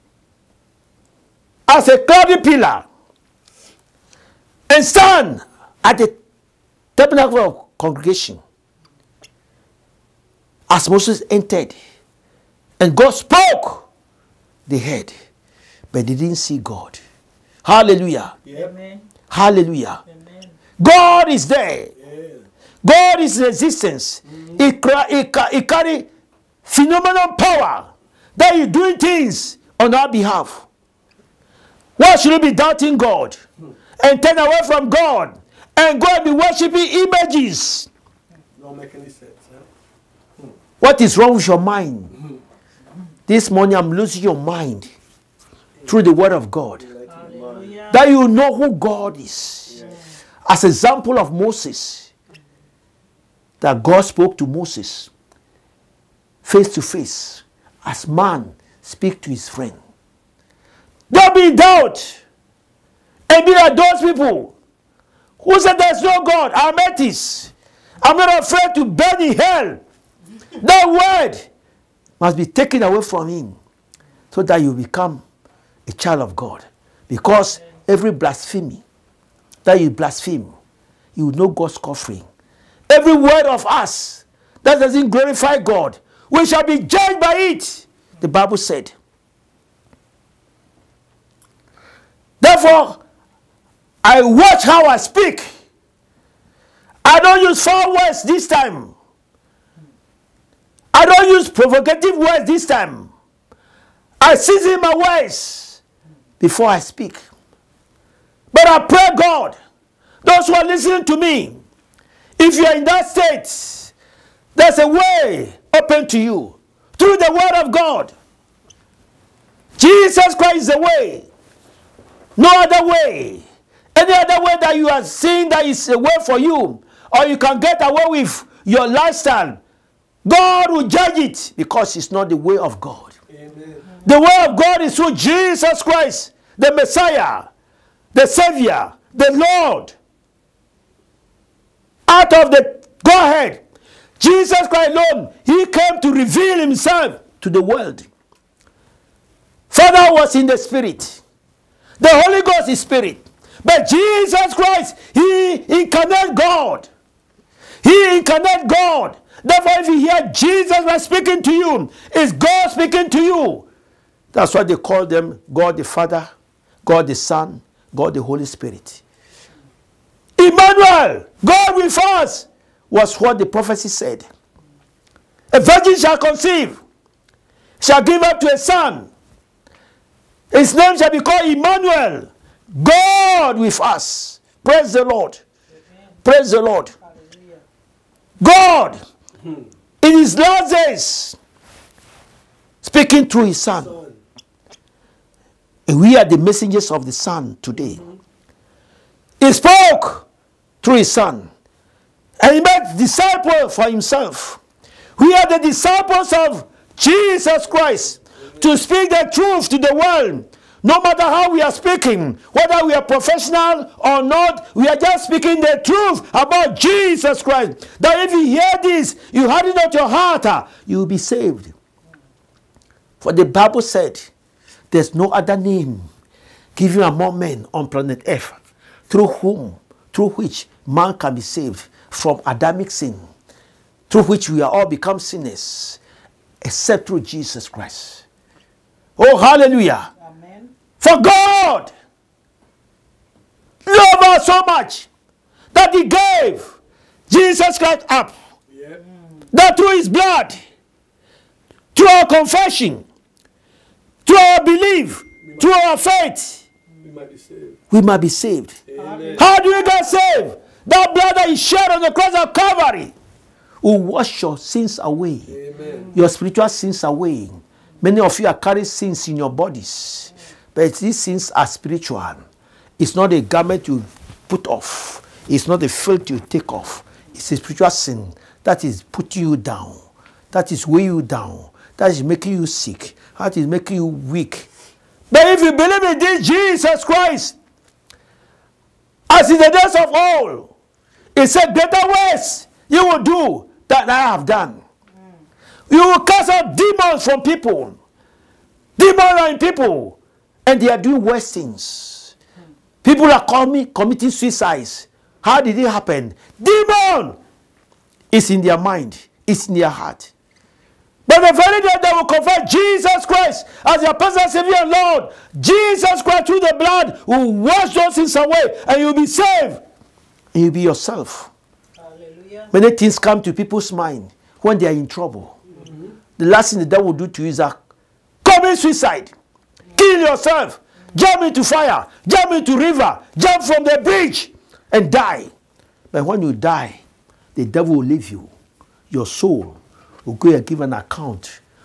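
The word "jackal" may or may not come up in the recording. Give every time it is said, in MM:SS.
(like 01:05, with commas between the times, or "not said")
not said.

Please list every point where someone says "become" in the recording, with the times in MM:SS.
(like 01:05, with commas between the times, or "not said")
01:14, 03:54.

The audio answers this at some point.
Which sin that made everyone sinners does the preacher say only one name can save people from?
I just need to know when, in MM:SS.
03:52.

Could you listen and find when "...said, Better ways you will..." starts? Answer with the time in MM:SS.
04:51.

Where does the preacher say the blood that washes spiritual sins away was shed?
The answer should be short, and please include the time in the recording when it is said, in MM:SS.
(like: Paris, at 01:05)
the cross of Calvary, at 04:22.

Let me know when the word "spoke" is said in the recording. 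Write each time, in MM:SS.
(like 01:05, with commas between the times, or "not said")
00:13, 00:54, 03:19.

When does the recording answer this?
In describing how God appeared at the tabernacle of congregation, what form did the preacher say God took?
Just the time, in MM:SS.
00:01.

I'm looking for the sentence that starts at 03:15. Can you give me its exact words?
And we are the messengers of the son today.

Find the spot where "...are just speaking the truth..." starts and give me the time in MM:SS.
03:34.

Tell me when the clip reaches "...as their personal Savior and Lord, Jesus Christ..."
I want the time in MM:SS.
05:13.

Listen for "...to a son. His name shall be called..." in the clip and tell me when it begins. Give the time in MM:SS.
02:58.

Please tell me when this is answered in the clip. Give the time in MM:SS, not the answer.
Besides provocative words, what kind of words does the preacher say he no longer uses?
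01:37.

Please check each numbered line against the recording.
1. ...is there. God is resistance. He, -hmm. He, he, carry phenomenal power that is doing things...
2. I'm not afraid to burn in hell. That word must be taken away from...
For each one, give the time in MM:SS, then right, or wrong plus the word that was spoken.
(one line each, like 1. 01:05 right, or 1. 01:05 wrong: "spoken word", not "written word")
1. 00:21 right
2. 01:08 right.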